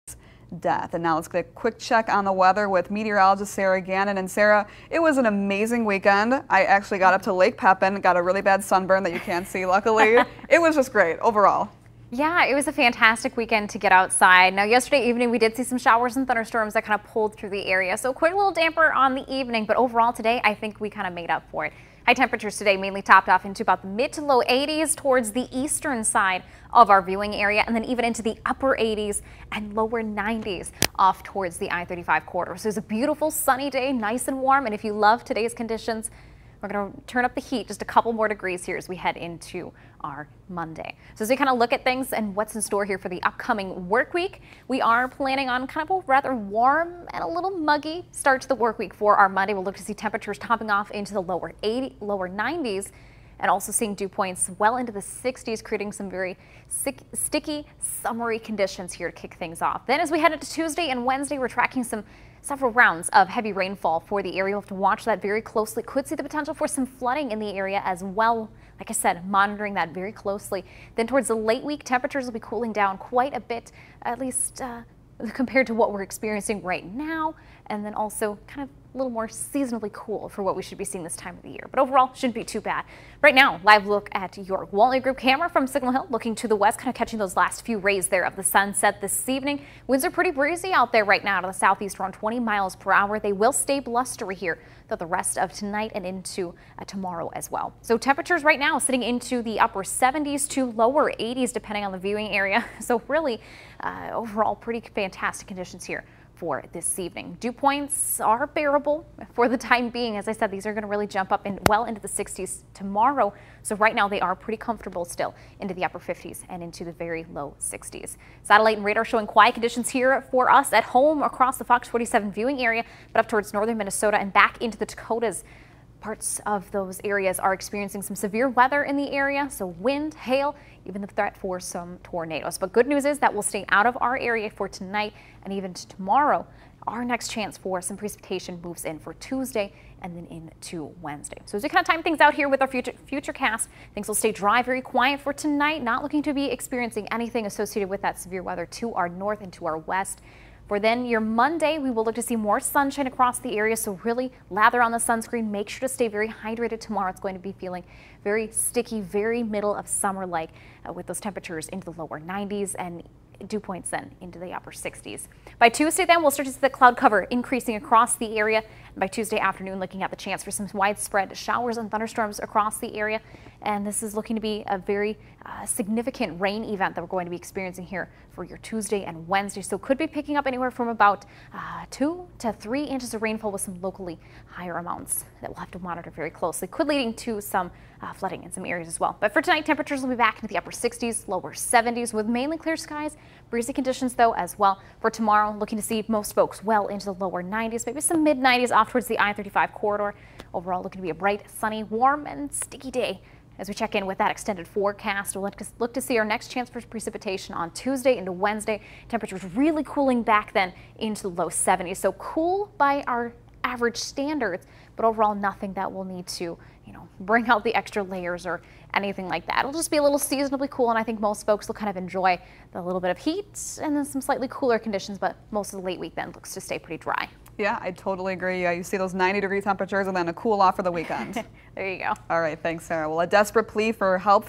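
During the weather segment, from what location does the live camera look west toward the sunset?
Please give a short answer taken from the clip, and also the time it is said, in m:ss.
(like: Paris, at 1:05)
Signal Hill, at 1:25.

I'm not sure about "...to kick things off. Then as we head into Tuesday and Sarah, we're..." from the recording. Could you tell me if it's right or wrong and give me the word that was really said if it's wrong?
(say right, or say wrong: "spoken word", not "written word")
wrong: "Wednesday", not "Sarah".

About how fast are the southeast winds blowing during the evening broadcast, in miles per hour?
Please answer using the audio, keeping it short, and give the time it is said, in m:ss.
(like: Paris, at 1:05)
20, at 1:32.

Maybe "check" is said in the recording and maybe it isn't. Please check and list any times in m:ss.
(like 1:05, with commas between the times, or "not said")
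0:01, 3:23.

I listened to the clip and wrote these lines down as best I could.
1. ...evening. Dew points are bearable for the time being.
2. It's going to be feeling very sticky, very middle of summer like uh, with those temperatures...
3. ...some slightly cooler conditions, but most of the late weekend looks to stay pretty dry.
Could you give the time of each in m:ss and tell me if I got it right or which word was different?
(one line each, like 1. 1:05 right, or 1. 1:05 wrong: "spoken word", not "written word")
1. 1:46 right
2. 2:37 right
3. 3:44 right.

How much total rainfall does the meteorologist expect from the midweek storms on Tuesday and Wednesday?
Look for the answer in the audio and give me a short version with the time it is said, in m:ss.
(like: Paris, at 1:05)
2 to 3 inches, at 3:01.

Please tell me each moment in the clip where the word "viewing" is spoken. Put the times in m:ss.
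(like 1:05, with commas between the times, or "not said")
0:27, 1:41, 2:02.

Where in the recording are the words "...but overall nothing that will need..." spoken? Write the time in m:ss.
3:34.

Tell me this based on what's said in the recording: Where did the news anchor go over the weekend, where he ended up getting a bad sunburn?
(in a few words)
Lake Pepin.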